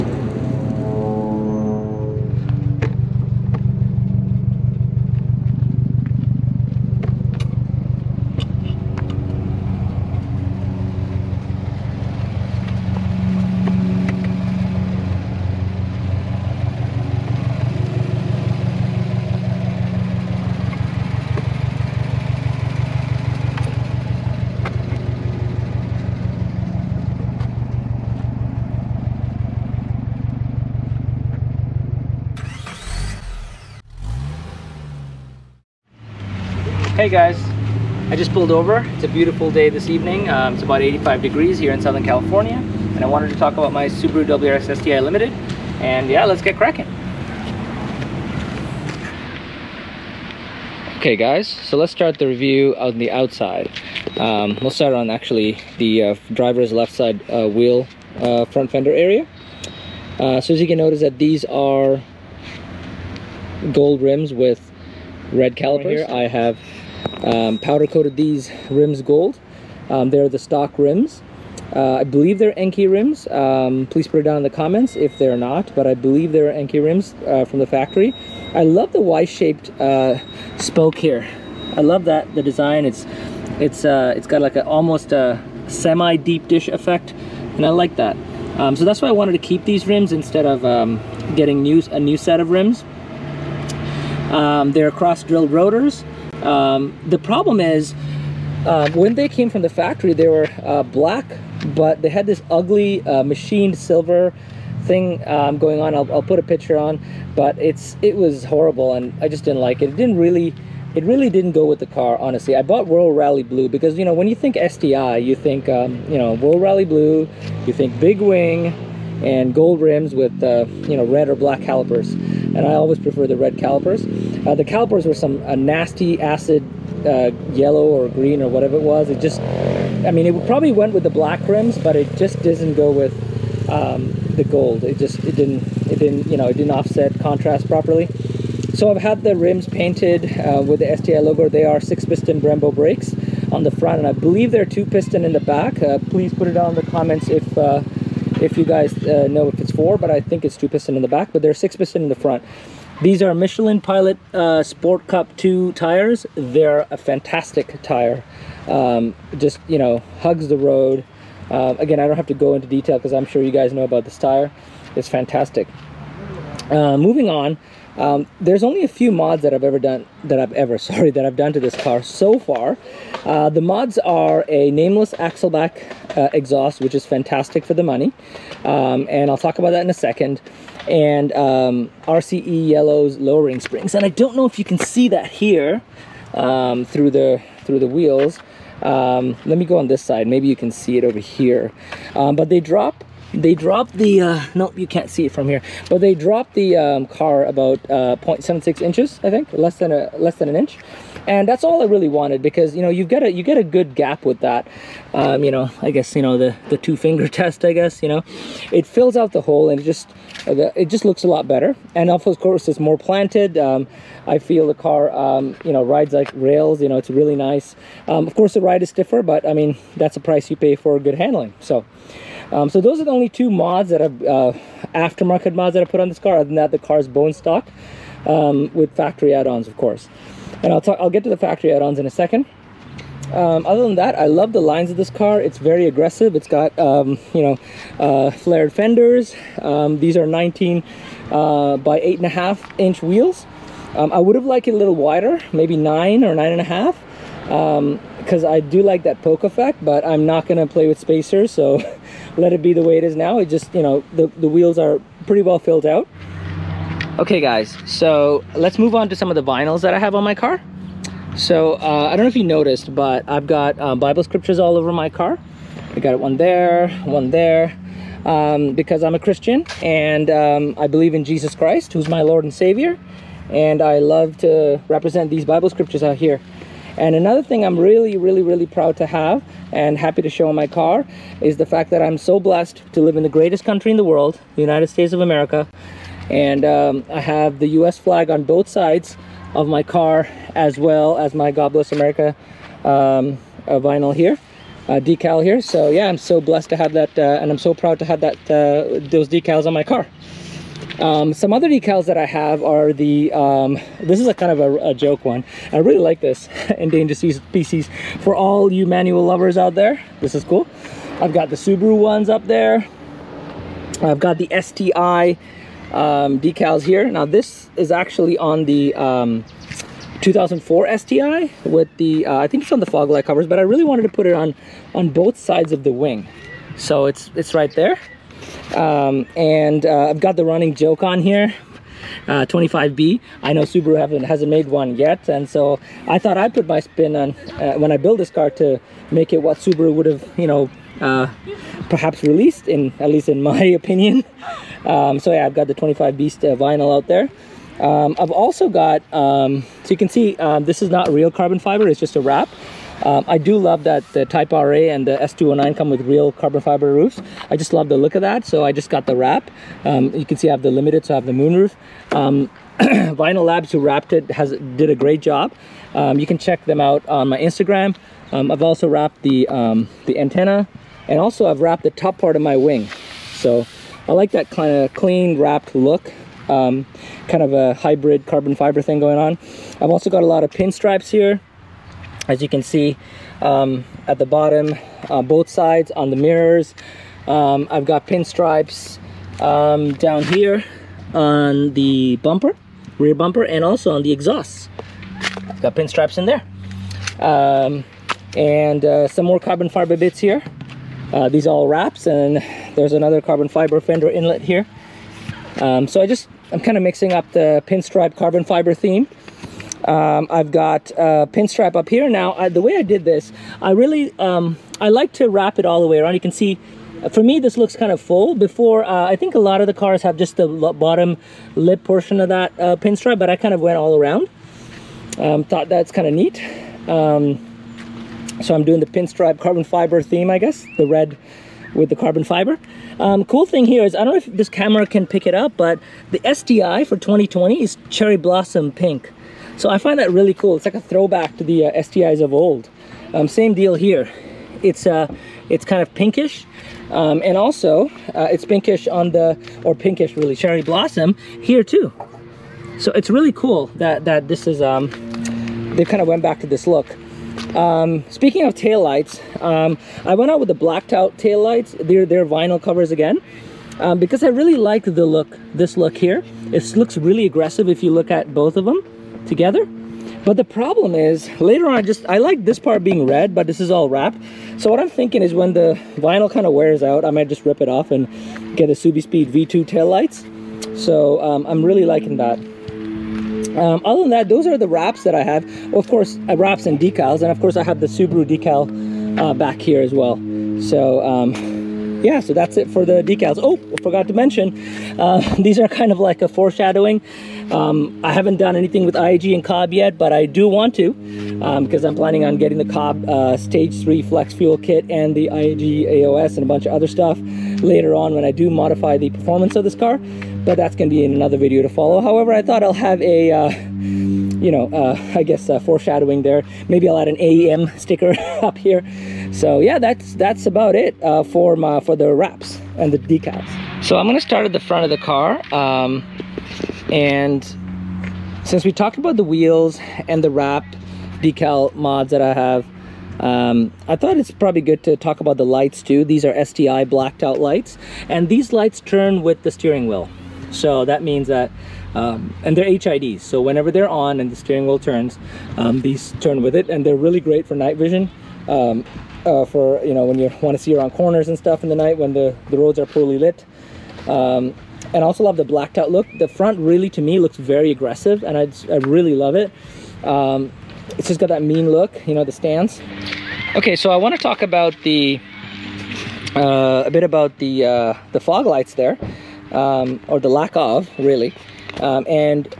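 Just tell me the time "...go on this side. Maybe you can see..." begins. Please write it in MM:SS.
03:09.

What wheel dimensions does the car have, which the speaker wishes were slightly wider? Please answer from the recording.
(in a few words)
19 by 8.5 inch.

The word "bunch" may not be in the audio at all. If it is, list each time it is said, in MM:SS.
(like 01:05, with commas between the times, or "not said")
08:26.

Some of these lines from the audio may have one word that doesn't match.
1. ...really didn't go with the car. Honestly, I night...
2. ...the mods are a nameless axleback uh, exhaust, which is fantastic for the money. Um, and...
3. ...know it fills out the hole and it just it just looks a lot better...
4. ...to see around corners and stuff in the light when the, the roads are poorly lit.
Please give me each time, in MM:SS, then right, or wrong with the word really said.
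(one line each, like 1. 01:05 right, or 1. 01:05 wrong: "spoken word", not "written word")
1. 01:51 wrong: "bought", not "night"
2. 02:53 right
3. 03:28 right
4. 09:10 wrong: "night", not "light".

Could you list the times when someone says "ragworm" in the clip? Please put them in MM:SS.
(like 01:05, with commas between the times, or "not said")
not said.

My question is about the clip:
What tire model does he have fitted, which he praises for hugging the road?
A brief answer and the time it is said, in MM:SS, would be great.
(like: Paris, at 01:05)
Michelin Pilot Sport Cup 2, at 02:33.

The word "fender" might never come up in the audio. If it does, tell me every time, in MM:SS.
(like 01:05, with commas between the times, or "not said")
00:58, 03:58, 06:43.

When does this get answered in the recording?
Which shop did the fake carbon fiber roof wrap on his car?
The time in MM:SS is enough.
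06:02.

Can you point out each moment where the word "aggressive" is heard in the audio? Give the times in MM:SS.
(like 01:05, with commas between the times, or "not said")
03:55, 07:47, 09:17.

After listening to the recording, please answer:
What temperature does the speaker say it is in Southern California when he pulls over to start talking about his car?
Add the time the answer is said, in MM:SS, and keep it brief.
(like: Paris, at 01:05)
85 degrees, at 00:40.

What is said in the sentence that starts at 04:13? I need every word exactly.
It just, you know, the, the wheels are pretty well filled out.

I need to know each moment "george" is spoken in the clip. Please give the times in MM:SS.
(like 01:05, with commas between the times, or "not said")
not said.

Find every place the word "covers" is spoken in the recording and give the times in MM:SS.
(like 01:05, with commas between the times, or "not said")
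05:23, 07:42.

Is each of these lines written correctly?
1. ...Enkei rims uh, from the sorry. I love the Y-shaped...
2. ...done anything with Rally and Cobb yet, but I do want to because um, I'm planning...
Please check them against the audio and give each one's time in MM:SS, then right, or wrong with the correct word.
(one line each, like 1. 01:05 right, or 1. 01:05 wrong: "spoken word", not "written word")
1. 01:16 wrong: "factory", not "sorry"
2. 08:18 wrong: "IAG", not "Rally".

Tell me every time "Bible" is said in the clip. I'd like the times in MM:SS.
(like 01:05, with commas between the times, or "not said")
04:23, 04:35.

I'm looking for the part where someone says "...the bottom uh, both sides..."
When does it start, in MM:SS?
06:24.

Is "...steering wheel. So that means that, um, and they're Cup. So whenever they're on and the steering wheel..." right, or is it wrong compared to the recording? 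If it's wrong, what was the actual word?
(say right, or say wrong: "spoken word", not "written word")
wrong: "HIDs", not "Cup".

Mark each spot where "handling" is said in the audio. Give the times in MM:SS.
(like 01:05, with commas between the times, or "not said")
03:41.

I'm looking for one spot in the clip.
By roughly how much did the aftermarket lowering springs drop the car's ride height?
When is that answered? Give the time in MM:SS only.
03:18.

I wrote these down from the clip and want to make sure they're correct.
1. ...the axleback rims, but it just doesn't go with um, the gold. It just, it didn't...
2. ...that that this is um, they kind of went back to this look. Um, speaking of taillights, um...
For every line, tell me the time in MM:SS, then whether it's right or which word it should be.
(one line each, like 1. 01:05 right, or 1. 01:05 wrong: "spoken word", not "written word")
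1. 02:11 wrong: "black", not "axleback"
2. 07:33 right.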